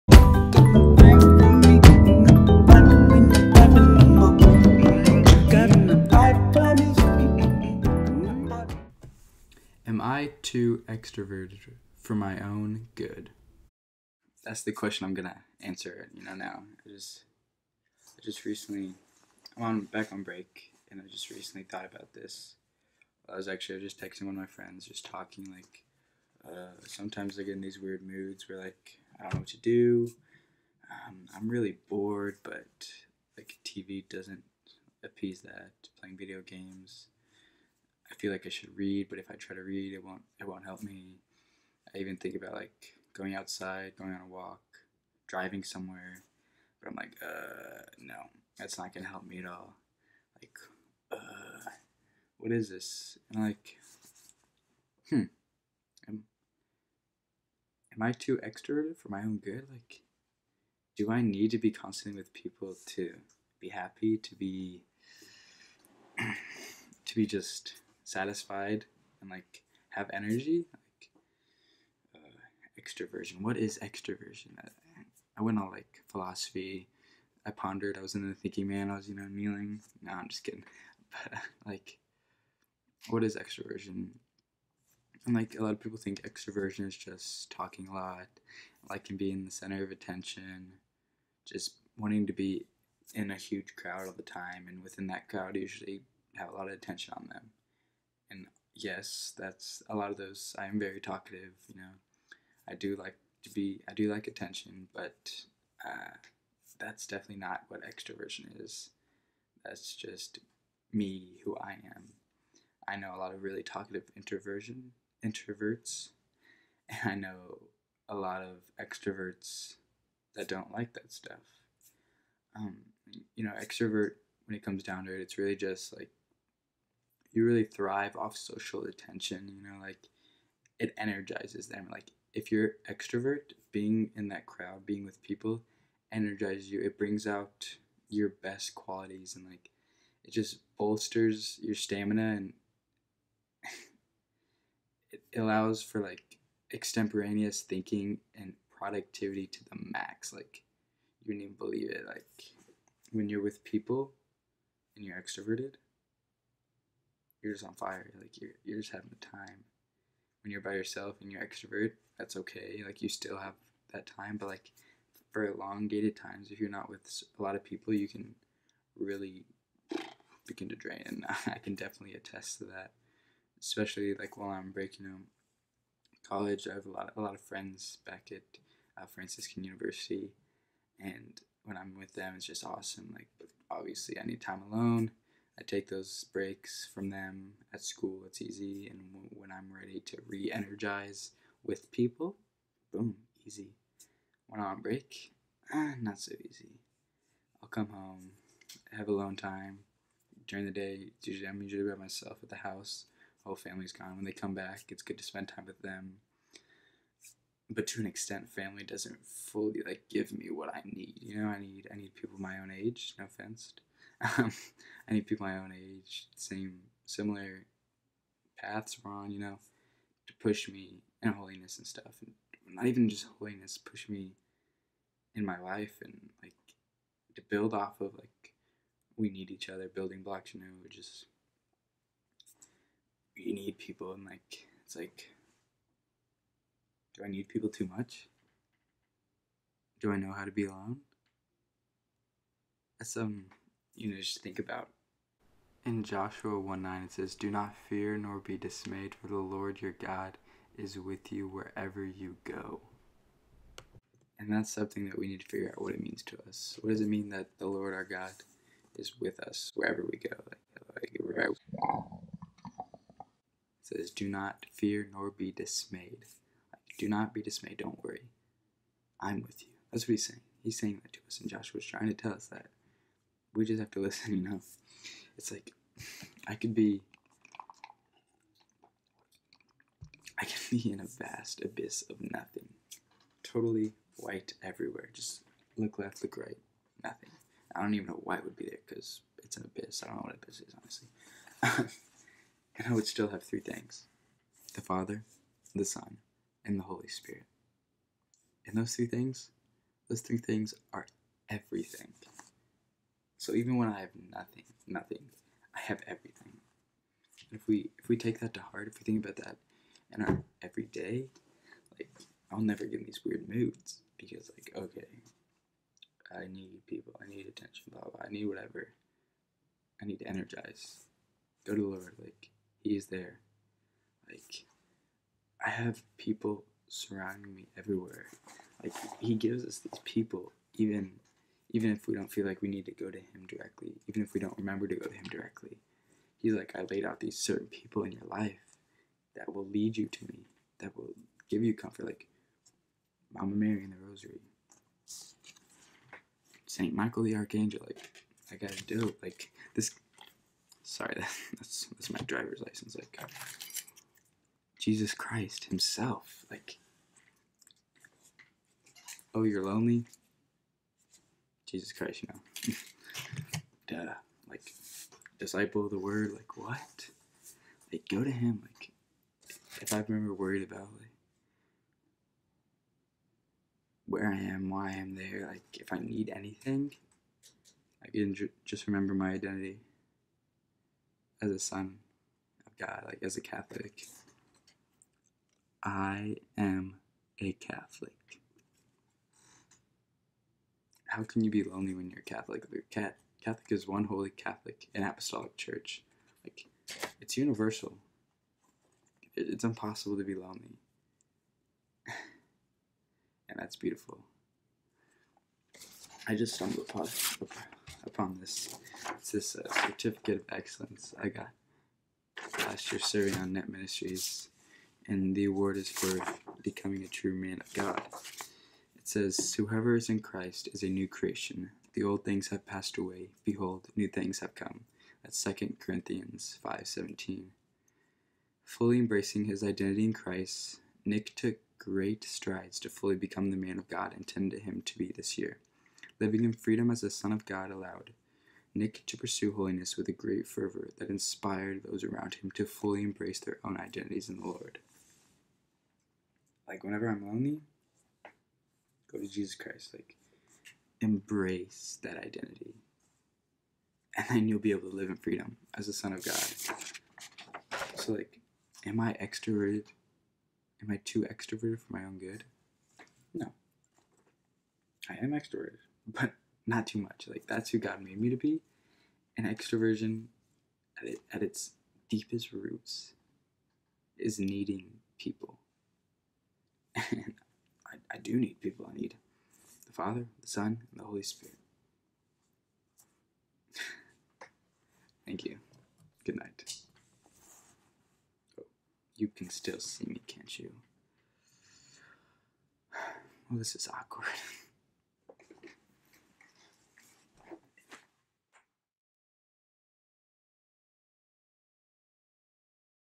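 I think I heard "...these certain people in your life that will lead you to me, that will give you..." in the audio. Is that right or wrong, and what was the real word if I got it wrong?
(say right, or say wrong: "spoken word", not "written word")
right.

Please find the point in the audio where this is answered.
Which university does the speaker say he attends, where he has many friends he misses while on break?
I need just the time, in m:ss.
2:59.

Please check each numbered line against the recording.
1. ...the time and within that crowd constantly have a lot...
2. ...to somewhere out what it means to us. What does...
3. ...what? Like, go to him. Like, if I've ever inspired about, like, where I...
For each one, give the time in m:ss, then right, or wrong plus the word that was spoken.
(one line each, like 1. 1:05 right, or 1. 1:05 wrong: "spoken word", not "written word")
1. 1:34 wrong: "usually", not "constantly"
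2. 4:15 wrong: "figure", not "somewhere"
3. 6:06 wrong: "worried", not "inspired".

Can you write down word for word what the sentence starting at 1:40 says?
I am very talkative, you know.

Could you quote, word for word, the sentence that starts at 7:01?
The old things have passed away.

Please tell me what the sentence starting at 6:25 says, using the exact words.
I am a Catholic how can you be lonely when you're Catholic?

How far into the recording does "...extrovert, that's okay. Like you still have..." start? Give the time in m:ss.
2:41.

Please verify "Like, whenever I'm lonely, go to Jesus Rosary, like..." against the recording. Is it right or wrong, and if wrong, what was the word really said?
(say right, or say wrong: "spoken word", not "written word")
wrong: "Christ", not "Rosary".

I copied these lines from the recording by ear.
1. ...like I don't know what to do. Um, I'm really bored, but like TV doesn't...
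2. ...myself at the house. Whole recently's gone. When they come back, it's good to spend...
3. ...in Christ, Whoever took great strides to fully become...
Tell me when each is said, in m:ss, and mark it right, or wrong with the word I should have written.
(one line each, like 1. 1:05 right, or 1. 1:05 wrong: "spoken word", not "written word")
1. 0:28 right
2. 3:21 wrong: "family", not "recently"
3. 7:10 wrong: "Nick", not "Whoever".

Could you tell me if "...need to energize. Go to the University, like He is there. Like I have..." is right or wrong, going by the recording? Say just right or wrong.
wrong.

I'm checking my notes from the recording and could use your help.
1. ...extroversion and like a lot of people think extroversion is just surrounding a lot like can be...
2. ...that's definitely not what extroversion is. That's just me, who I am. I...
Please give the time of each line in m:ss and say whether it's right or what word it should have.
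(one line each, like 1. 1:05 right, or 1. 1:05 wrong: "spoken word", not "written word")
1. 1:23 wrong: "talking", not "surrounding"
2. 1:46 right.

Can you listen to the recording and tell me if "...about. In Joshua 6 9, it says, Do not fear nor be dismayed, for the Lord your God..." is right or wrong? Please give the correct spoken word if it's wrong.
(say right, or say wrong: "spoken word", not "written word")
wrong: "1", not "6".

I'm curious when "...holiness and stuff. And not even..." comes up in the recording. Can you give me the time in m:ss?
3:41.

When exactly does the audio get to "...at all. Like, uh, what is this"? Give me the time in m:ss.
0:49.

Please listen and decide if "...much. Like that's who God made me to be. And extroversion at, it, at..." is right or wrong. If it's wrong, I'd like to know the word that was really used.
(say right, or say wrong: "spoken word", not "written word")
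right.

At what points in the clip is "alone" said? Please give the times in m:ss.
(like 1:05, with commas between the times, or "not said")
3:04, 3:19, 4:00.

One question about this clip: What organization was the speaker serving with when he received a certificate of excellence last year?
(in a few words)
Net Ministries.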